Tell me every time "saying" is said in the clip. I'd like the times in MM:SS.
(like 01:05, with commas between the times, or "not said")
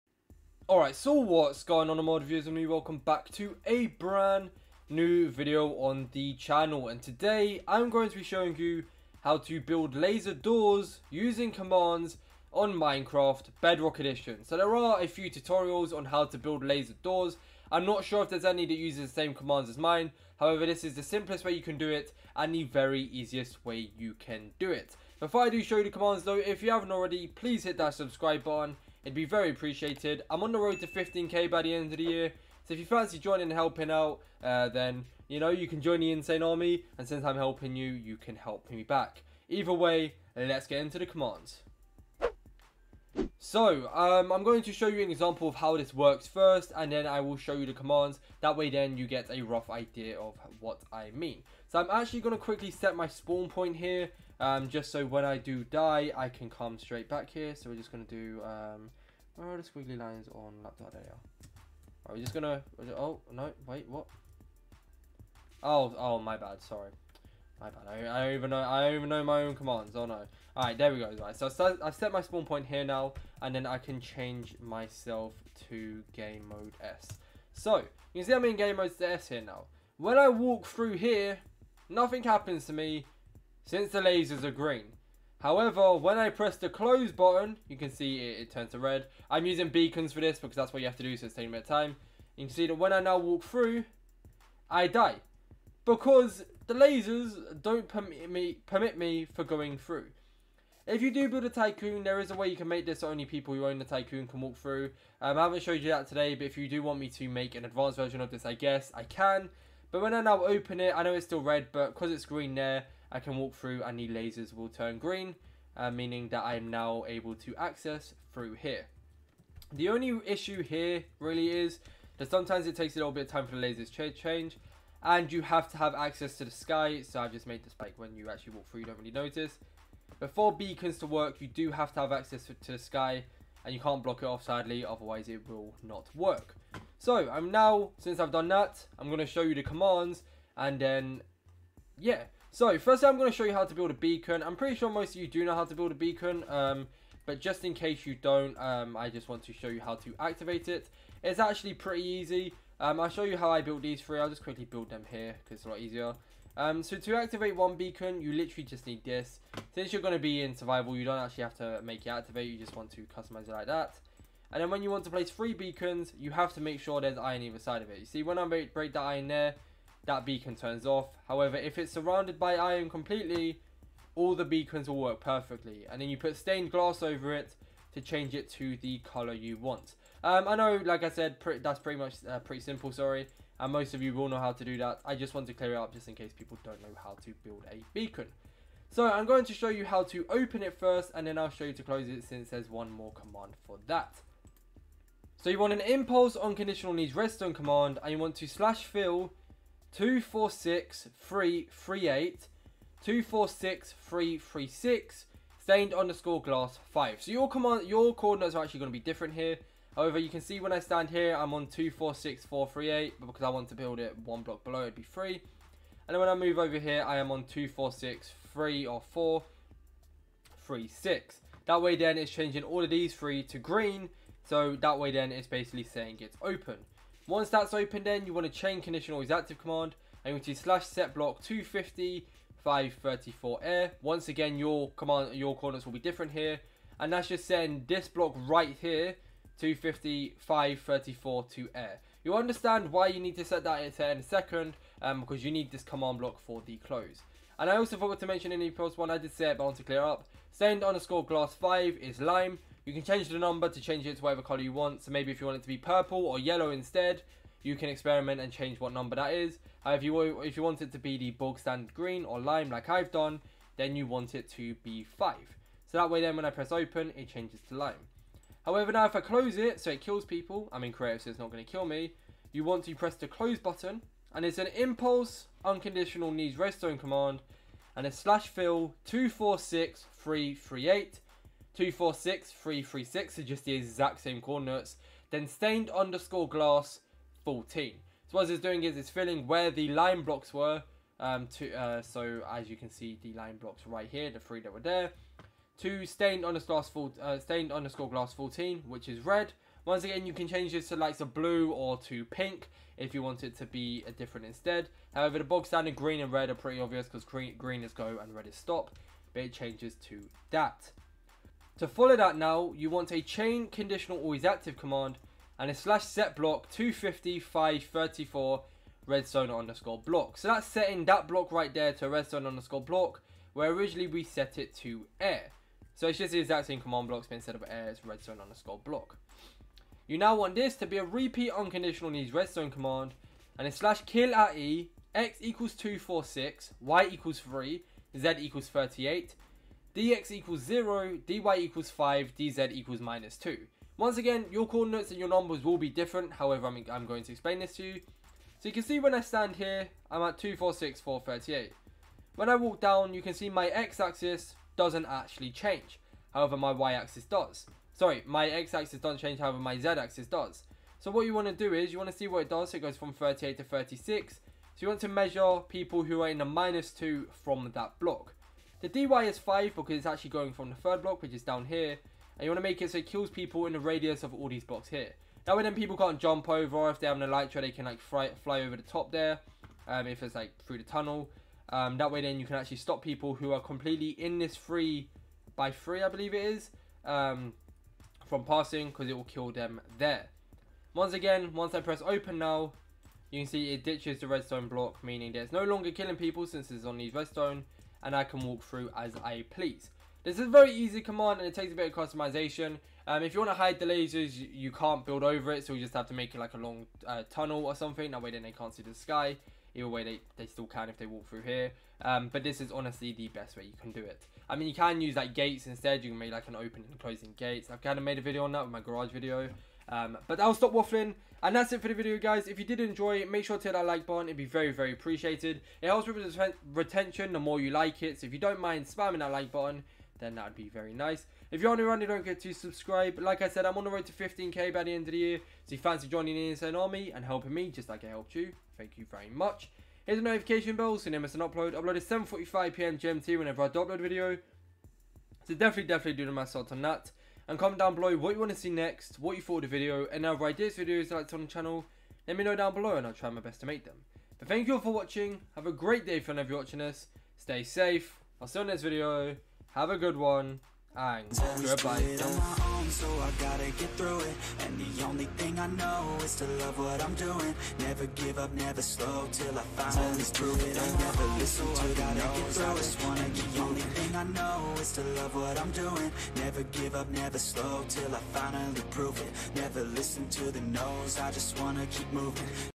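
03:45, 03:57.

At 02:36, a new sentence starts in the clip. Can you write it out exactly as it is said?
Um, so to activate one beacon, you literally just need this.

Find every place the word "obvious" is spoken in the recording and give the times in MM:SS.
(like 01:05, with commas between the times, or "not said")
05:06.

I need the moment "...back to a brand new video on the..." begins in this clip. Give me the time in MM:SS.
00:02.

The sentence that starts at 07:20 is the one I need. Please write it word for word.
Hit the notification bell so you never miss an upload.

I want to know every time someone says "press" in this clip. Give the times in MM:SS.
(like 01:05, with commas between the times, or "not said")
01:26, 04:26, 04:32, 06:31.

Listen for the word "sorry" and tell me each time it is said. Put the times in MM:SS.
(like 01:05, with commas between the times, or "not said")
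01:06, 03:02, 05:57.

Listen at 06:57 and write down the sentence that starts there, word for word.
I've kind of made a video on that with my garage video.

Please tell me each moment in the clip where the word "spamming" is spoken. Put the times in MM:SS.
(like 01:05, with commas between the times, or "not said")
07:08.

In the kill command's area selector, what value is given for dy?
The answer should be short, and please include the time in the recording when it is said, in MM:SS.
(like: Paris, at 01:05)
5, at 05:41.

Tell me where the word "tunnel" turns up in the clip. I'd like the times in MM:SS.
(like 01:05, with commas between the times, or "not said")
06:20, 06:47.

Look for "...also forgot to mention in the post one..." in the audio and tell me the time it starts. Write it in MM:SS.
04:07.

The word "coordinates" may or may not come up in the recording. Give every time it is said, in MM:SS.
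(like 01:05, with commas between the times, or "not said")
03:28, 03:55, 04:44, 05:44.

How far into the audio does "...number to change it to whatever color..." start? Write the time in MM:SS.
04:13.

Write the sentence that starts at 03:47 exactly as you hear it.
Once that's open then, you want to chain condition always active command, and you want to slash set block 250 534 air.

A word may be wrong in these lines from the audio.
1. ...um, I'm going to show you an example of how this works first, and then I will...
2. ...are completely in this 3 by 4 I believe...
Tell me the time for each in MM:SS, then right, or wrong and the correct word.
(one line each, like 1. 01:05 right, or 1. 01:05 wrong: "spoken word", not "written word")
1. 00:43 right
2. 06:23 wrong: "3", not "4".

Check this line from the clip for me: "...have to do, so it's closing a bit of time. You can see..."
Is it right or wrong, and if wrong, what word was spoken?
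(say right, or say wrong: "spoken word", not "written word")
wrong: "taking", not "closing".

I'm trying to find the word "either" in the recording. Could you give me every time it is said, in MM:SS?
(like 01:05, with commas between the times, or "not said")
00:39, 02:47, 06:49.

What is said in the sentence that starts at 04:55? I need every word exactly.
To stained underscore glass, uh, stained underscore glass 14, which is red.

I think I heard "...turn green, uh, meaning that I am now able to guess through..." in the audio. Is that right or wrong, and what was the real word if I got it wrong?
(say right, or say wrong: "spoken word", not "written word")
wrong: "access", not "guess".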